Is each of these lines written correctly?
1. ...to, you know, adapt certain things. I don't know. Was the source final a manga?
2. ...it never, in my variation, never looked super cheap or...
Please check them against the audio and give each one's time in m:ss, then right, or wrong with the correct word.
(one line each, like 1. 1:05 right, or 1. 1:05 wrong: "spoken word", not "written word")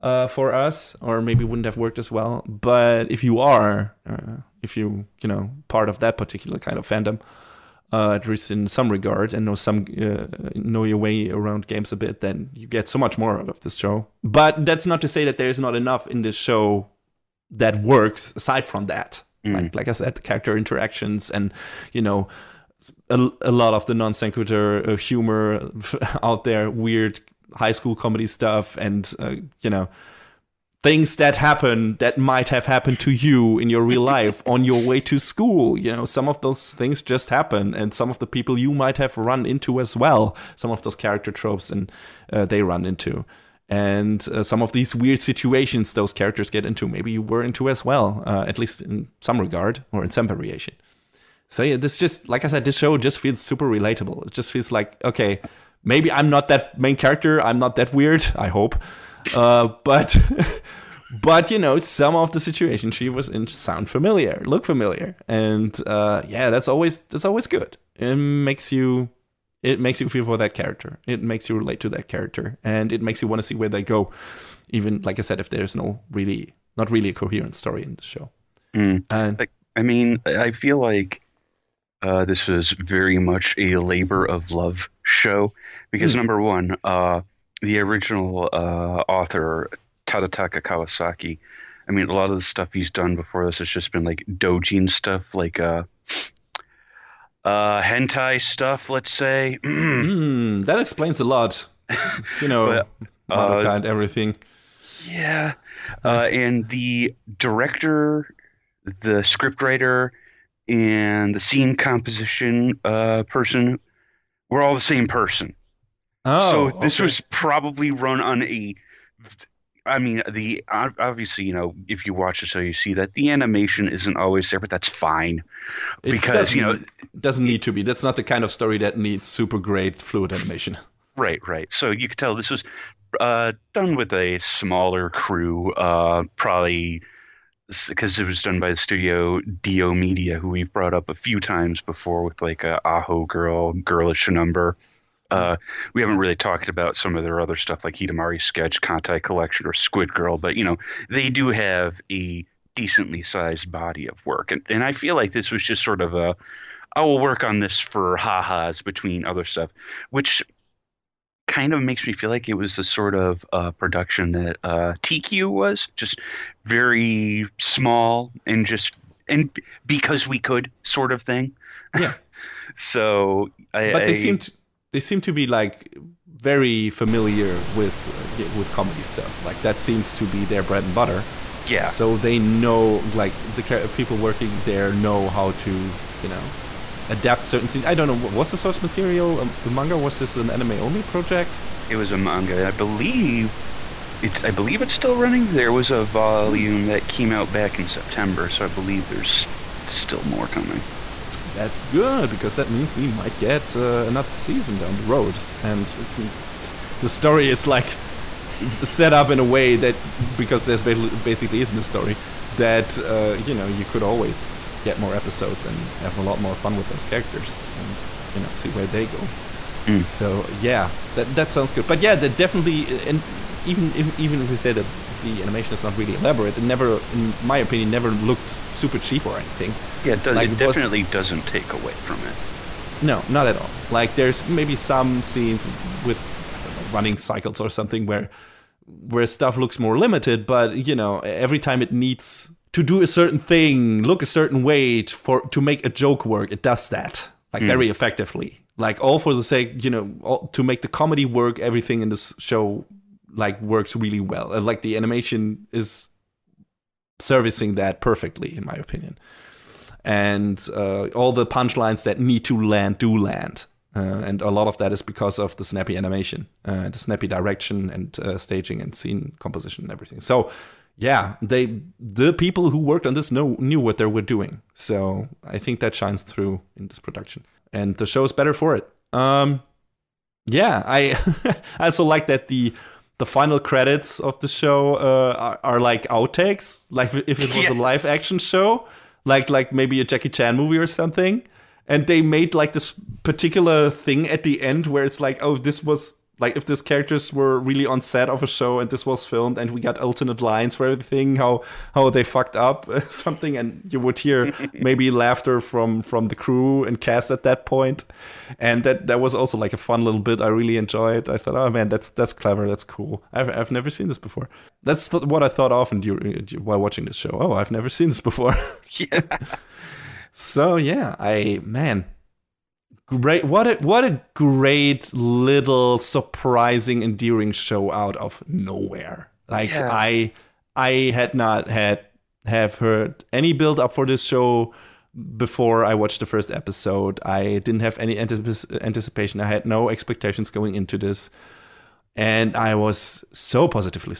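1. 3:05 wrong: "material", not "final"
2. 3:46 wrong: "opinion", not "variation".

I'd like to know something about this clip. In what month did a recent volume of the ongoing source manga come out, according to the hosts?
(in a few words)
September.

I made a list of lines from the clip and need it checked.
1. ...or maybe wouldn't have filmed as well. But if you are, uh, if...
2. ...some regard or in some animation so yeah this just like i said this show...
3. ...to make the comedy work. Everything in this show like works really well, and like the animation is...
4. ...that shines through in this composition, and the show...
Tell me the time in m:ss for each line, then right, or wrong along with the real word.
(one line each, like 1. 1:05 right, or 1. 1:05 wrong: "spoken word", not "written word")
1. 0:01 wrong: "worked", not "filmed"
2. 0:49 wrong: "variation", not "animation"
3. 4:10 right
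4. 4:35 wrong: "production", not "composition".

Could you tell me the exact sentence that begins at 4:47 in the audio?
a live action show, like like maybe a Jackie Chan movie or something.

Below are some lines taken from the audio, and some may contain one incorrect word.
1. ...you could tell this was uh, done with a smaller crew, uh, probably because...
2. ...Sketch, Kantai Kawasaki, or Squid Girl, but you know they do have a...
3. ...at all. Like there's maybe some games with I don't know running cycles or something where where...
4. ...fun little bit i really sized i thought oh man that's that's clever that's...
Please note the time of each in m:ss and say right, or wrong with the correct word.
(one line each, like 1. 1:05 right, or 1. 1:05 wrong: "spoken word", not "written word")
1. 2:11 right
2. 2:28 wrong: "Collection", not "Kawasaki"
3. 3:53 wrong: "scenes", not "games"
4. 5:09 wrong: "enjoyed", not "sized".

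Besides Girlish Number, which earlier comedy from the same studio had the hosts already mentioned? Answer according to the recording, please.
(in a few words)
Aho Girl.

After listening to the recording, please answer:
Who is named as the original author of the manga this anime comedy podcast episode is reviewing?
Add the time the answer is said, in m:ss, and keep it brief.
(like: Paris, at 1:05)
Tadataka Kawasaki, at 1:30.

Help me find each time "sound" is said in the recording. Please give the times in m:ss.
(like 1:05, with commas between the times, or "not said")
1:03, 3:41.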